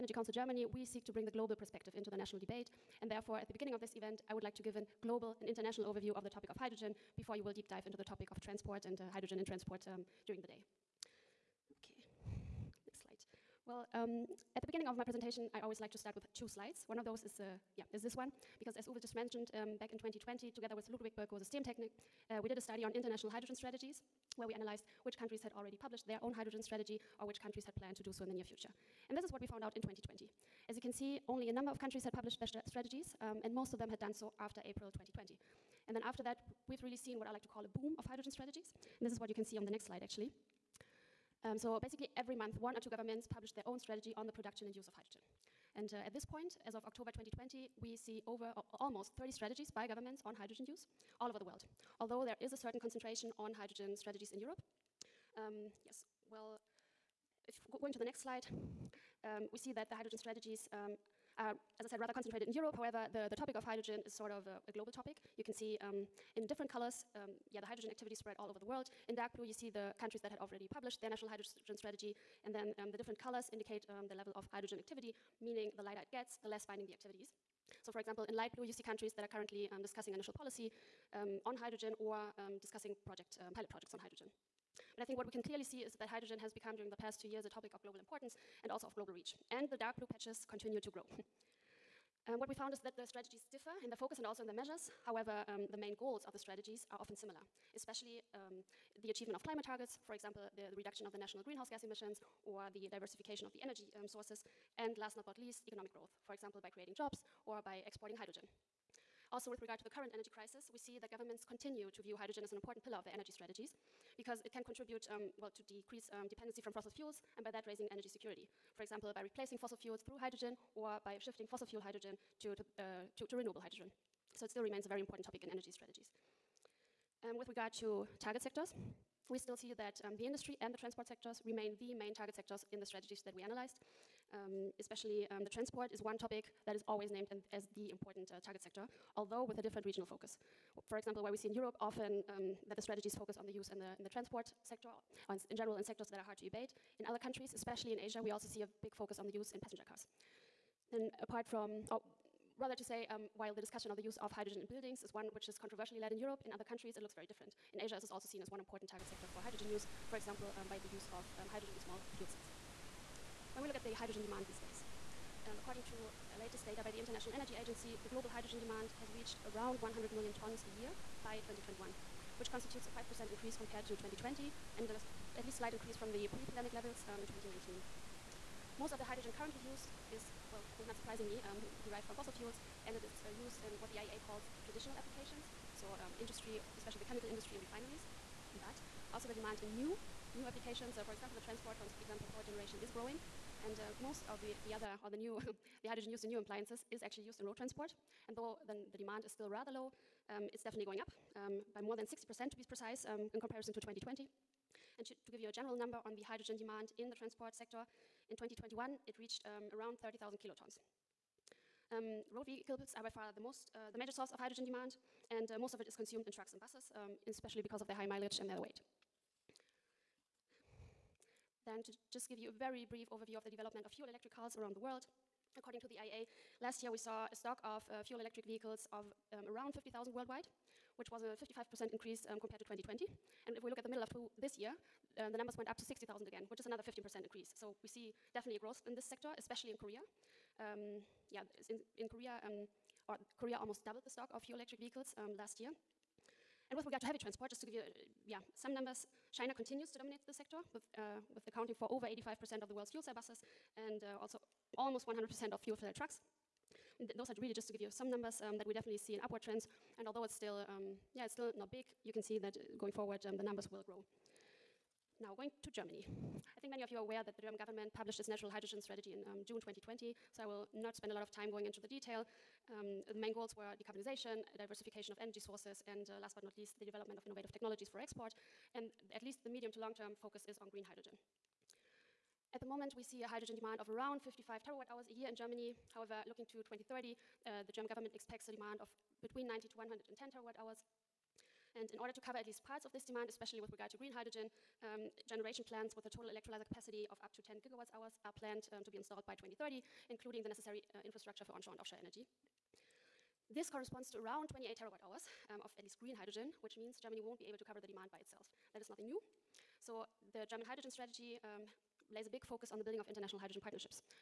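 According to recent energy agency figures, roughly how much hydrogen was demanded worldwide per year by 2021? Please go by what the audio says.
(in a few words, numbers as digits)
100 million tons.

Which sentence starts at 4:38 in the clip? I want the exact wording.
And at least the medium to long term focus is on green hydrogen.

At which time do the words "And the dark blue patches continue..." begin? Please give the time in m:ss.
1:29.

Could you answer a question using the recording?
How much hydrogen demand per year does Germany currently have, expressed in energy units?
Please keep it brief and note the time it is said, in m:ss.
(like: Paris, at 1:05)
55 terawatt hours, at 4:44.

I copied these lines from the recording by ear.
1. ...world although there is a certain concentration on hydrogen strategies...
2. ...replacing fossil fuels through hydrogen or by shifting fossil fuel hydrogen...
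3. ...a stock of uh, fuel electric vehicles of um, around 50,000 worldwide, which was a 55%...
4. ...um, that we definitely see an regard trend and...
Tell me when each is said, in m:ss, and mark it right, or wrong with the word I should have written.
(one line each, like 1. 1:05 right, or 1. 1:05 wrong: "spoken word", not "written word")
1. 0:51 right
2. 1:59 right
3. 3:47 right
4. 4:18 wrong: "upward", not "regard".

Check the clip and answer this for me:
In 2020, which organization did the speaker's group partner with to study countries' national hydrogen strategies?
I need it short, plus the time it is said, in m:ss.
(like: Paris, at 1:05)
Ludwig Berko Systemtechnik, at 0:20.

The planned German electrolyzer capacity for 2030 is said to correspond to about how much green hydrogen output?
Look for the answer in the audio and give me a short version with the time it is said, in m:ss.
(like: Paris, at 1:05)
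28 terawatt hours, at 5:04.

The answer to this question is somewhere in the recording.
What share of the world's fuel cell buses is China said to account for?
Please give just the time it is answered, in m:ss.
4:11.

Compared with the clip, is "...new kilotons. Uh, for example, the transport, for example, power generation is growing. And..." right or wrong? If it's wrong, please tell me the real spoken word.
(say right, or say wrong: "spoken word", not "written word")
wrong: "applications", not "kilotons".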